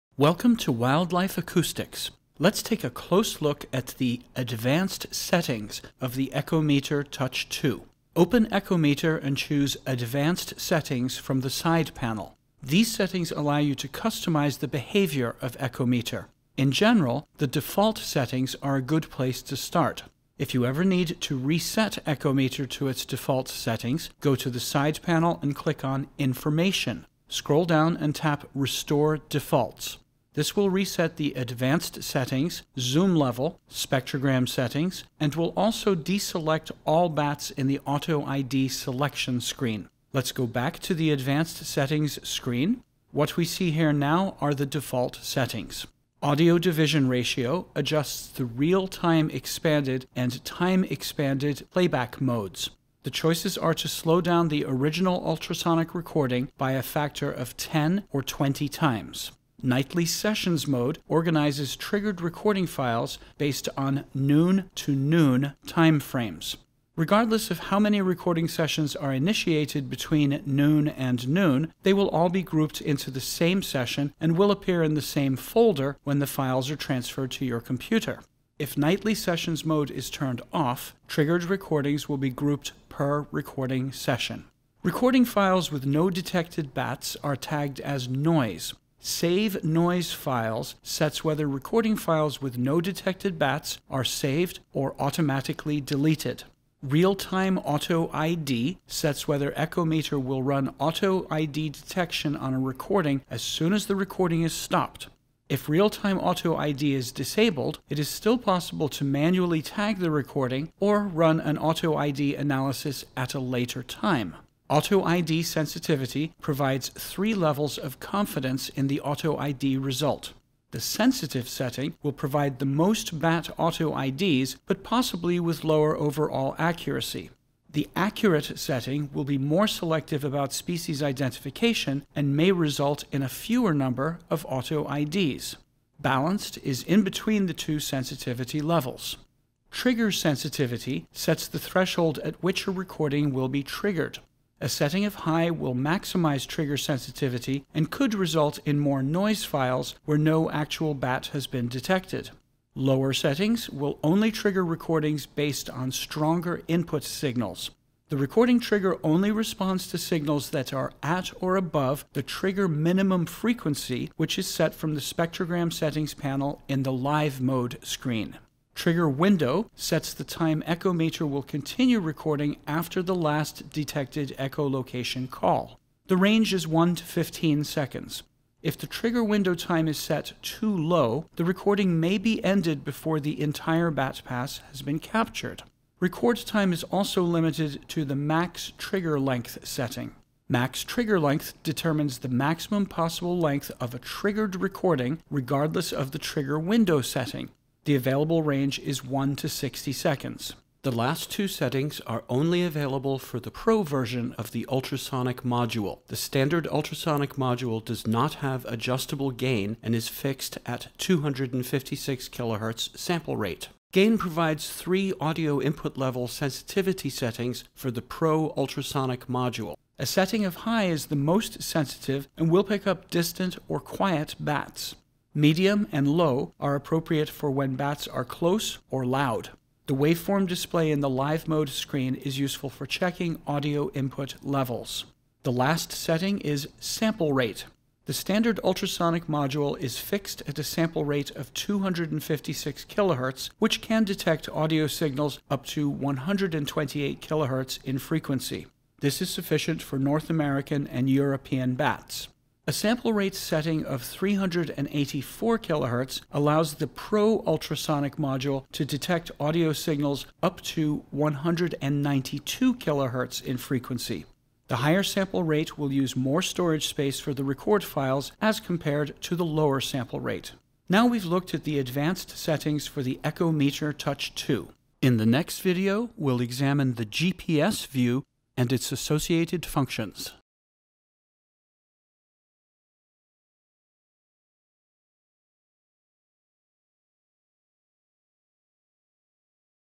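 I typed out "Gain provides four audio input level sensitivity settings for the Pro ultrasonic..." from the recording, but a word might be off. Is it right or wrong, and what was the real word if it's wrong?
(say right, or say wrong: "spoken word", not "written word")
wrong: "three", not "four".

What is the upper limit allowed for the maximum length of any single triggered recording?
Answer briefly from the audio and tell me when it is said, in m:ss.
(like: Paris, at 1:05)
60 seconds, at 3:19.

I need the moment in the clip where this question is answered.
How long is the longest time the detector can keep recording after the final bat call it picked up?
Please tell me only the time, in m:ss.
2:57.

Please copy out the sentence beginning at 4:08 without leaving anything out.
This is sufficient for North American and European bats.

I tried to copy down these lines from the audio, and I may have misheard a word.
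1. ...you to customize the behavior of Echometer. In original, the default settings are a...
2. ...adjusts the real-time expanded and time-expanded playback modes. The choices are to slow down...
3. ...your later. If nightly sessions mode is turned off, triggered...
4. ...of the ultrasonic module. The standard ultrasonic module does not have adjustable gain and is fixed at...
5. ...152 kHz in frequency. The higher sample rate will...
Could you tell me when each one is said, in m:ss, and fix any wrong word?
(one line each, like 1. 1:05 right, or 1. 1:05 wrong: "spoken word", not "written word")
1. 0:13 wrong: "general", not "original"
2. 0:47 right
3. 1:17 wrong: "computer", not "later"
4. 3:24 right
5. 4:21 wrong: "192", not "152".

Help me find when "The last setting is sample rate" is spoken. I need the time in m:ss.
3:55.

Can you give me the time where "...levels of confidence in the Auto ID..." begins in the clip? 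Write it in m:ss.
1:57.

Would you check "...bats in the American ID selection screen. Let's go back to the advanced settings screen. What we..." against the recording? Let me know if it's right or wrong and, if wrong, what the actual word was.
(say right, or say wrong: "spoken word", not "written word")
wrong: "Auto", not "American".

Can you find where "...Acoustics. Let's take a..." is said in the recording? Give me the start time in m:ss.
0:01.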